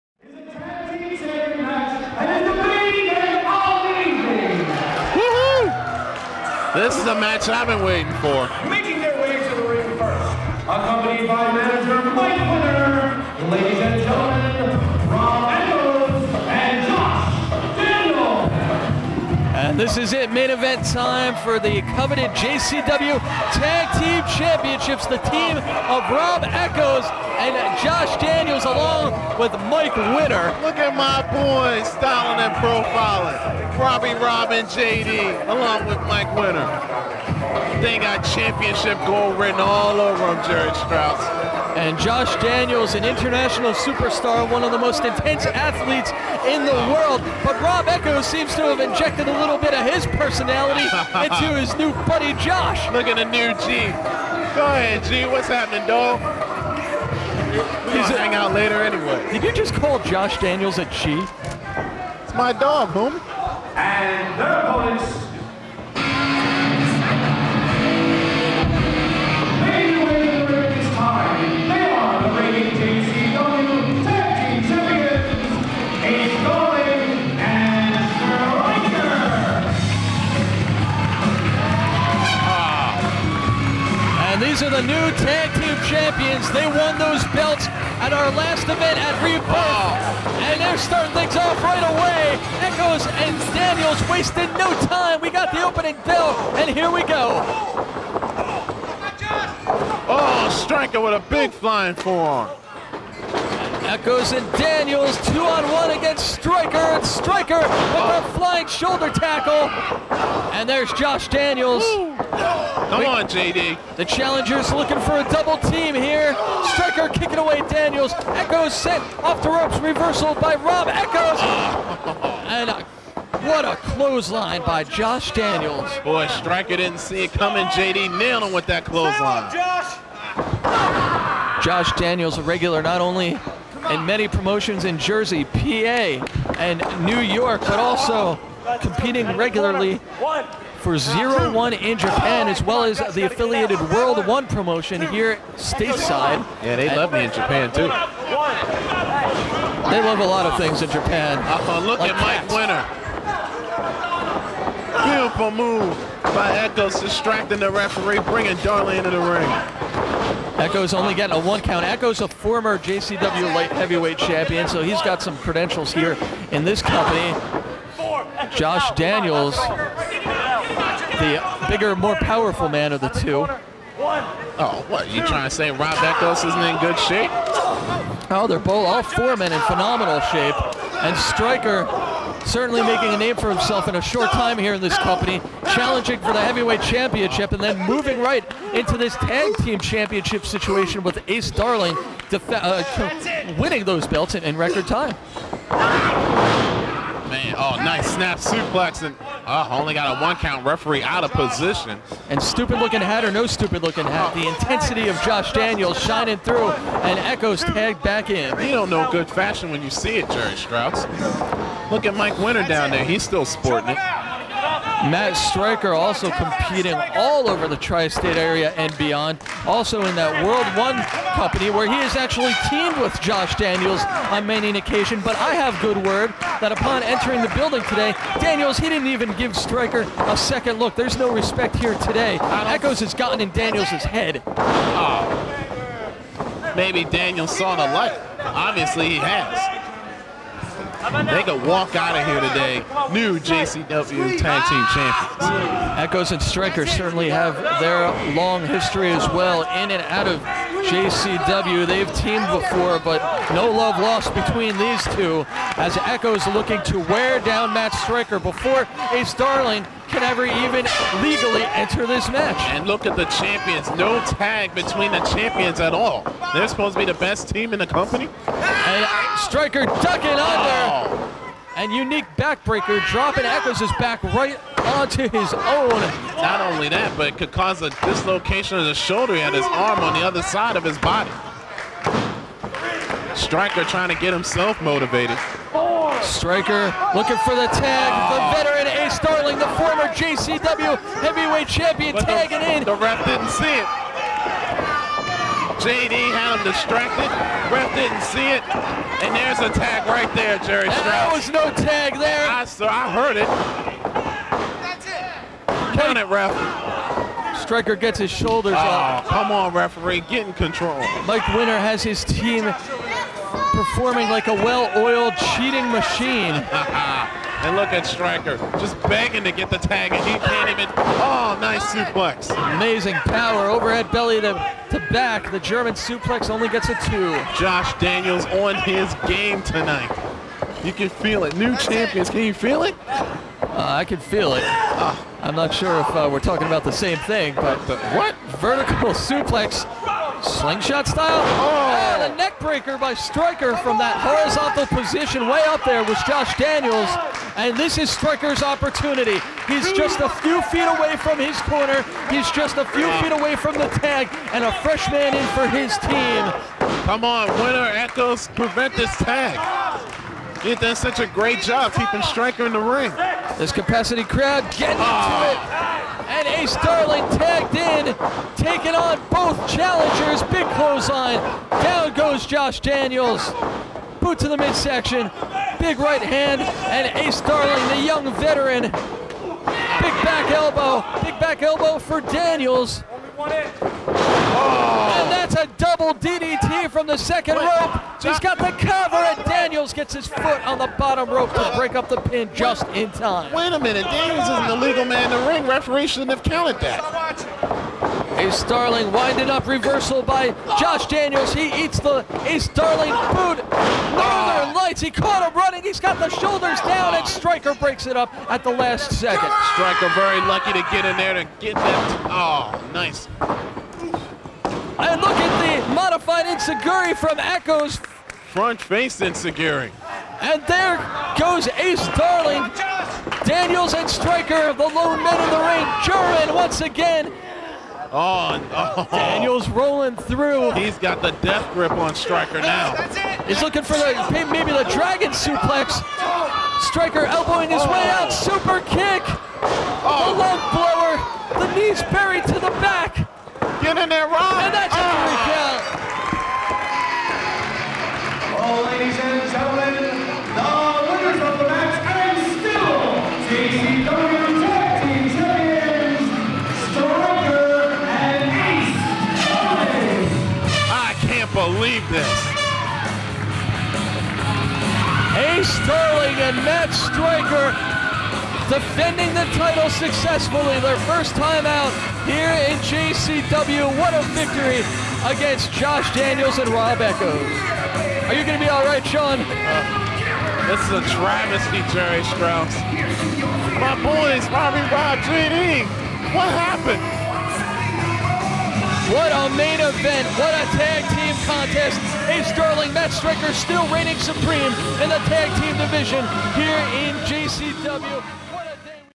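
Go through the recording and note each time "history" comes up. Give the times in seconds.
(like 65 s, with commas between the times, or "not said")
248 s.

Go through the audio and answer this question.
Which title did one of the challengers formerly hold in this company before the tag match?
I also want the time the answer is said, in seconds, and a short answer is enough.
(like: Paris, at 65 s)
JCW light heavyweight champion, at 162 s.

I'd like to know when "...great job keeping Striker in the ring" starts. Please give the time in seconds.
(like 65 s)
361 s.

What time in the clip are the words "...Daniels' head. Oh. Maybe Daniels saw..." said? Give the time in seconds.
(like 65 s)
233 s.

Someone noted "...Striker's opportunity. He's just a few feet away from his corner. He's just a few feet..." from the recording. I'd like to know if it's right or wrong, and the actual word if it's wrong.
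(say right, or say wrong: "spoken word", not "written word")
right.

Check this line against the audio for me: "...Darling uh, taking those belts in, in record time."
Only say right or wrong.
wrong.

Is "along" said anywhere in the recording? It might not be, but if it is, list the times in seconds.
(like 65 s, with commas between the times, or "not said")
28 s, 35 s.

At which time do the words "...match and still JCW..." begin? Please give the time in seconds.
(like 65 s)
451 s.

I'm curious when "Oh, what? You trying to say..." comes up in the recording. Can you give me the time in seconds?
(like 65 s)
173 s.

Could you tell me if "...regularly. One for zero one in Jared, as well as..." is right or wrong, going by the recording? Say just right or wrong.
wrong.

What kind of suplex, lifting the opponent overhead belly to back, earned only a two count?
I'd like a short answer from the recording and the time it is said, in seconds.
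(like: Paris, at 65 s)
German suplex, at 325 s.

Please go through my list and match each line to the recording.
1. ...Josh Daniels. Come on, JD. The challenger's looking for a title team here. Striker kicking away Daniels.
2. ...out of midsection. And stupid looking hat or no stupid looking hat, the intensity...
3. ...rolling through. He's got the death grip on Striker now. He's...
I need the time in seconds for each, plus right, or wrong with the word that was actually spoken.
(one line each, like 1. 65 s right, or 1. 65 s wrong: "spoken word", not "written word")
1. 110 s wrong: "double", not "title"
2. 201 s wrong: "position", not "midsection"
3. 429 s right.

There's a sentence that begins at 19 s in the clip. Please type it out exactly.
This is it, main event time for the coveted JCW Tag Team Championships.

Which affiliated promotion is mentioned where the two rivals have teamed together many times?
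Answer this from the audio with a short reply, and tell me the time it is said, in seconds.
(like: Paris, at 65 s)
World One, at 220 s.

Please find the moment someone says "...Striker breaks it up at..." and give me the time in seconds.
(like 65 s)
407 s.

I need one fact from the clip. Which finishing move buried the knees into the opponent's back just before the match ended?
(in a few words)
lung blower.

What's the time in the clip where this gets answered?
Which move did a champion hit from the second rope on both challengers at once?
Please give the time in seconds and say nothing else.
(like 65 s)
385 s.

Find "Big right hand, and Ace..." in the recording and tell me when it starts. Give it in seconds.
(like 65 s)
375 s.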